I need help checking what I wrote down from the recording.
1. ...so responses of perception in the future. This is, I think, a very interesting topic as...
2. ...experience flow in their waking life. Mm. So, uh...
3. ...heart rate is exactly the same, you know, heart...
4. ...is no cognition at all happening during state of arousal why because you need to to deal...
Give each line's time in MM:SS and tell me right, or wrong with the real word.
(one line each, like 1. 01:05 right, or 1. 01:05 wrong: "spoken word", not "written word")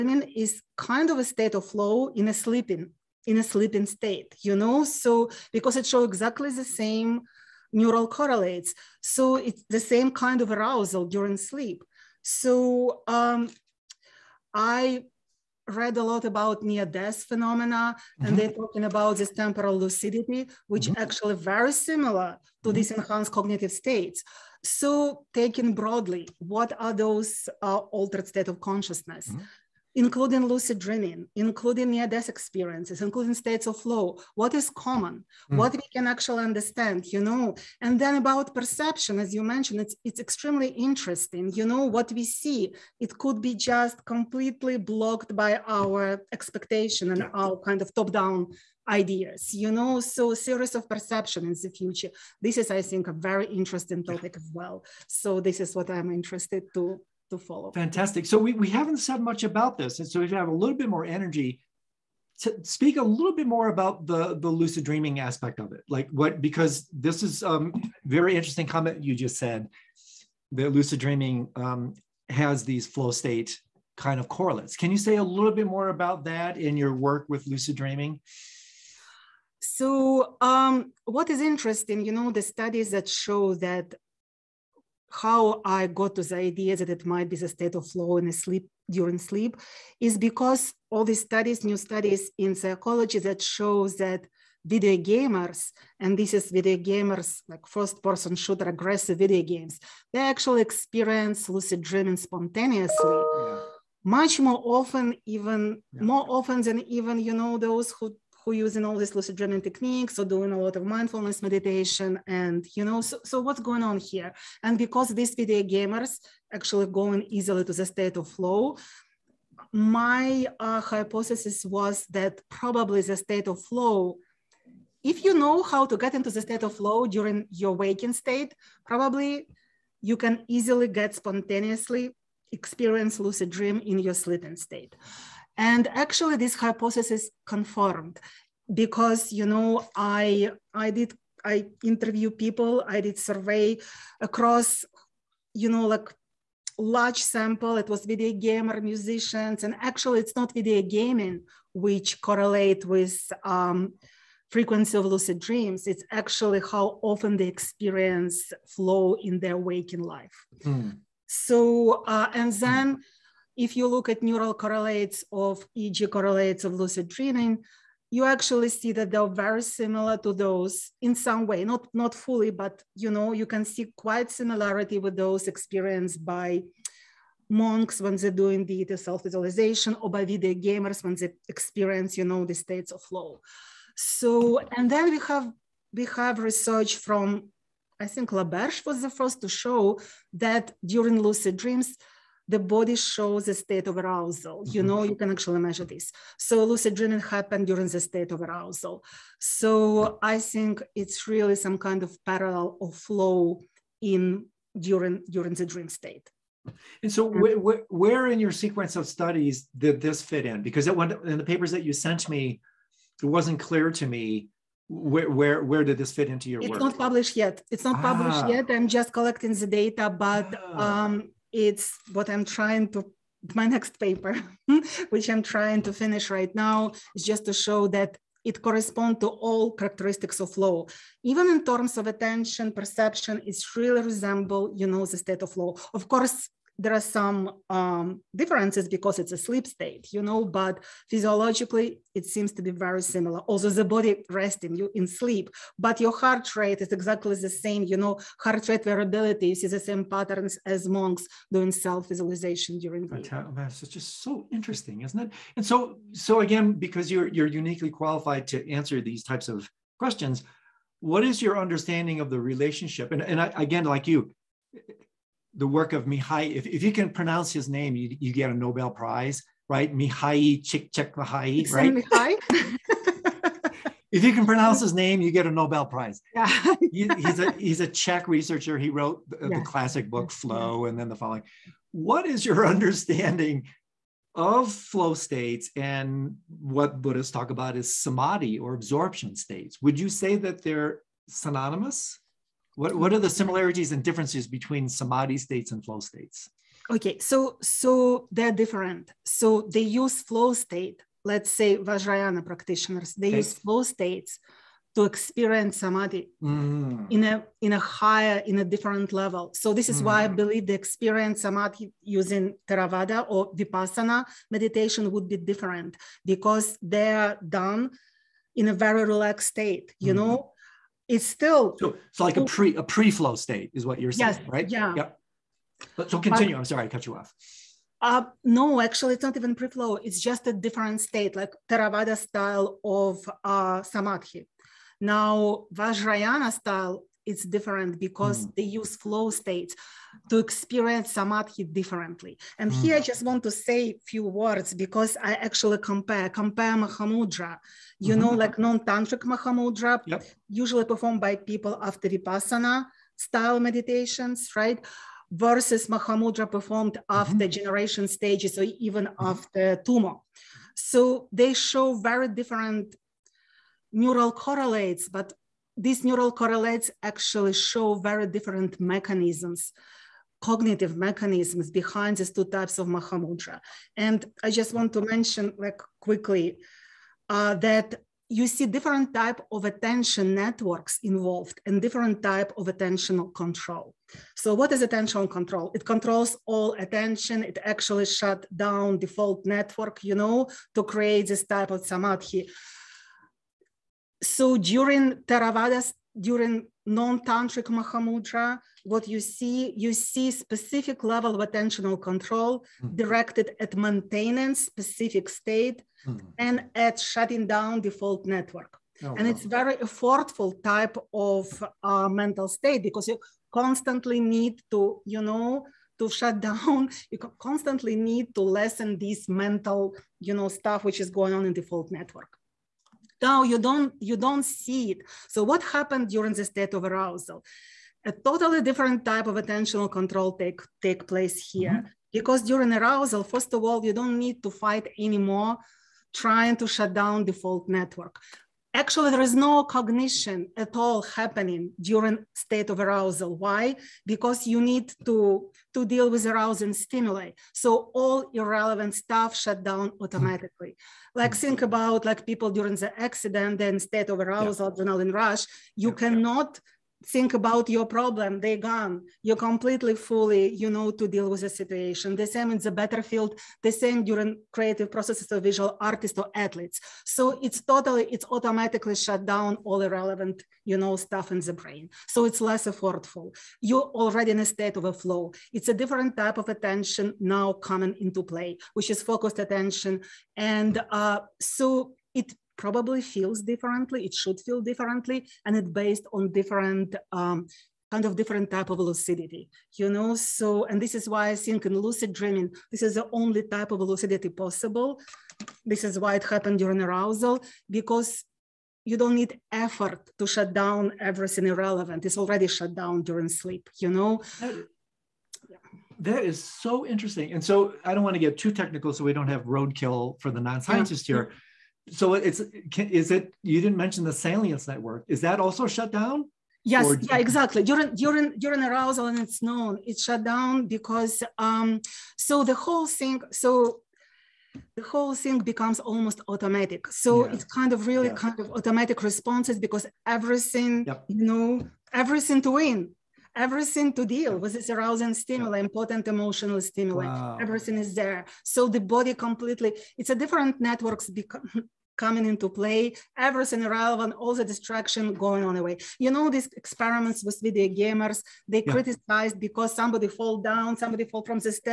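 1. 00:49 wrong: "series", not "responses"
2. 02:37 right
3. 04:06 right
4. 07:19 right.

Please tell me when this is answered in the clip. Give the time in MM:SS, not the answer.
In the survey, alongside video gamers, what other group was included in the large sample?
02:28.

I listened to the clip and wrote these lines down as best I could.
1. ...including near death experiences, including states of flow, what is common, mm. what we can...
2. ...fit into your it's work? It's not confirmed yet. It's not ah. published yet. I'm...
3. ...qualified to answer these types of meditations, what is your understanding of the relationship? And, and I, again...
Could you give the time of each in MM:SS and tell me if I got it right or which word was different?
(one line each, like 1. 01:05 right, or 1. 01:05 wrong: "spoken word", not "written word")
1. 00:31 right
2. 03:36 wrong: "published", not "confirmed"
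3. 04:17 wrong: "questions", not "meditations".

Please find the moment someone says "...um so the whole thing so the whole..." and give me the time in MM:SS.
08:41.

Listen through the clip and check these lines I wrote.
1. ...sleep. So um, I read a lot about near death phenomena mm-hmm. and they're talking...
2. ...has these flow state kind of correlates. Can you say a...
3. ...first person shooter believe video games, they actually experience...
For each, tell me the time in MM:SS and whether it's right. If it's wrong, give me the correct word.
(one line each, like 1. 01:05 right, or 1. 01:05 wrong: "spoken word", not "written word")
1. 00:11 right
2. 01:12 right
3. 01:37 wrong: "aggressive", not "believe".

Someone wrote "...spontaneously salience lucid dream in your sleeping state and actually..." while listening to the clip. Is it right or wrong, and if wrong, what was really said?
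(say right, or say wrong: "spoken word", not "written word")
wrong: "experience", not "salience".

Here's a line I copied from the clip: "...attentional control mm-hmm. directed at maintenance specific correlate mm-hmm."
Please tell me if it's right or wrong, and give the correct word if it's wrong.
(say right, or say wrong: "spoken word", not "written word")
wrong: "state", not "correlate".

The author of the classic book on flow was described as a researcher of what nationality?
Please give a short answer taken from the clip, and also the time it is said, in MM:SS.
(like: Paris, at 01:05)
Czech, at 04:37.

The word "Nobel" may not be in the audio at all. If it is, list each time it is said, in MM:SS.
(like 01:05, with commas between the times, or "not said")
04:28, 04:35.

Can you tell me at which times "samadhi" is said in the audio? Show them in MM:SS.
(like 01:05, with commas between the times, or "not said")
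04:47, 04:54, 05:05, 05:11, 05:33, 05:41, 06:31.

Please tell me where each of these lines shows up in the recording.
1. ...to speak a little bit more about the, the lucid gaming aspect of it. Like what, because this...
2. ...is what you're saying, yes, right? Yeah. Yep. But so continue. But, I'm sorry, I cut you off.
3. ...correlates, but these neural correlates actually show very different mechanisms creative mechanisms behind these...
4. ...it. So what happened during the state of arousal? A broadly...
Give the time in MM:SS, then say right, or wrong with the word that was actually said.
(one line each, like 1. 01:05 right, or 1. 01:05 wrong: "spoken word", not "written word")
1. 01:02 wrong: "dreaming", not "gaming"
2. 05:23 right
3. 06:04 wrong: "cognitive", not "creative"
4. 07:04 wrong: "totally", not "broadly".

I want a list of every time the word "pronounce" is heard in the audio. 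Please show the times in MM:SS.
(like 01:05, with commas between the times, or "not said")
04:27, 04:34.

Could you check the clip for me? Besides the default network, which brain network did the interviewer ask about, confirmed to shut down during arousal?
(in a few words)
Salience network.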